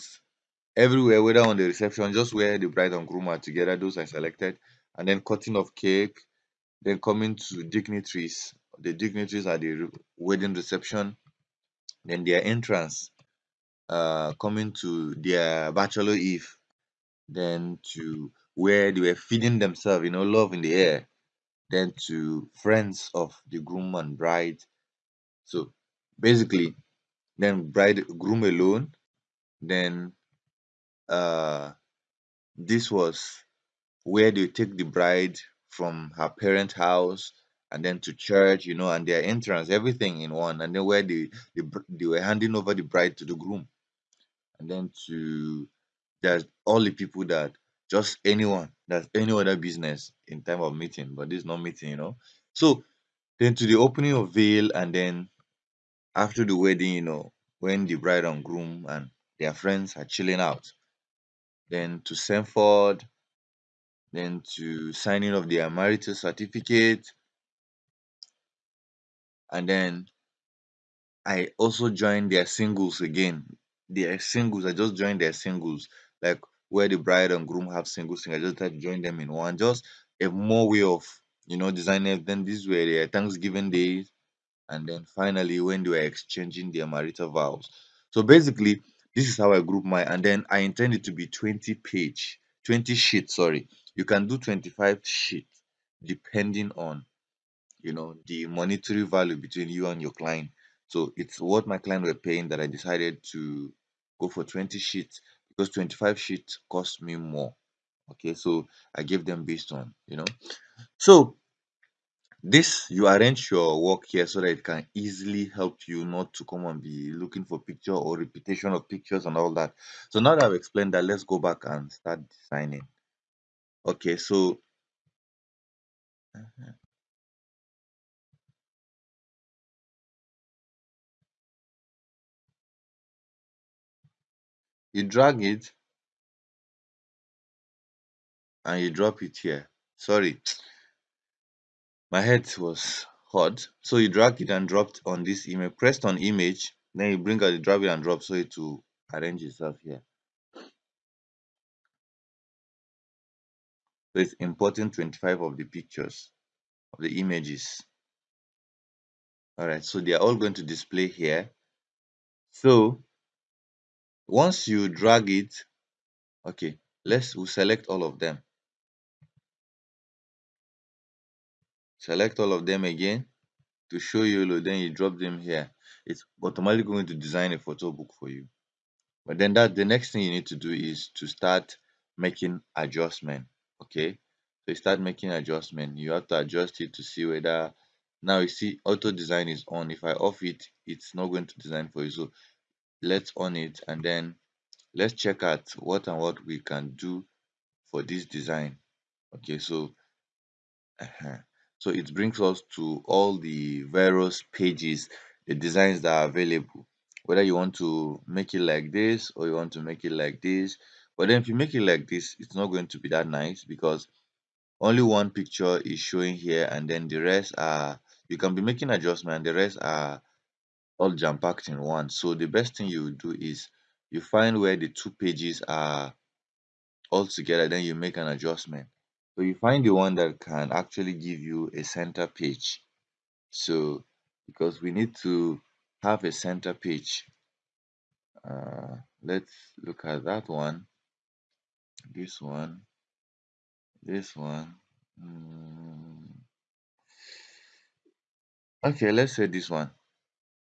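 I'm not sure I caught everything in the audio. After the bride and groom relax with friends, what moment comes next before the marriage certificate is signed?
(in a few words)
Sanford.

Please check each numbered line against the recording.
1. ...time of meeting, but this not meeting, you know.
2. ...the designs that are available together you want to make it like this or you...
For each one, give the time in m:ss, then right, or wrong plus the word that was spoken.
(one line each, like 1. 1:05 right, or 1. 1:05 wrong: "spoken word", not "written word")
1. 0:50 right
2. 3:25 wrong: "whether", not "together".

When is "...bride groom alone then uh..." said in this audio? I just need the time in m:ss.
0:27.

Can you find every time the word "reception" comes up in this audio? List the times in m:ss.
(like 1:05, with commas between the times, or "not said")
0:01, 0:10.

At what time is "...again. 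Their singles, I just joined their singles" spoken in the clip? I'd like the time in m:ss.
1:13.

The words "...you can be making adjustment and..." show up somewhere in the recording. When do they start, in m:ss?
3:38.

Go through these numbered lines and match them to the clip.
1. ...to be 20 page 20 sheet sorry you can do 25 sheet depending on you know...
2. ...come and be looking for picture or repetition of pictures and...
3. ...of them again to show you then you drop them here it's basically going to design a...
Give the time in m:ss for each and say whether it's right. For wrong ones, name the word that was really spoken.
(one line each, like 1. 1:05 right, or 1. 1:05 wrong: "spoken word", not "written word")
1. 1:31 right
2. 1:56 right
3. 2:52 wrong: "automatically", not "basically".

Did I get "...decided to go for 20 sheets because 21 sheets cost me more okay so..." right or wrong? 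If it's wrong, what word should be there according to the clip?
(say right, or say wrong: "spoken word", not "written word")
wrong: "25", not "21".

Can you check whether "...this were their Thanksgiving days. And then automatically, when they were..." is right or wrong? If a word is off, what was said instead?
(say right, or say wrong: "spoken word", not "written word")
wrong: "finally", not "automatically".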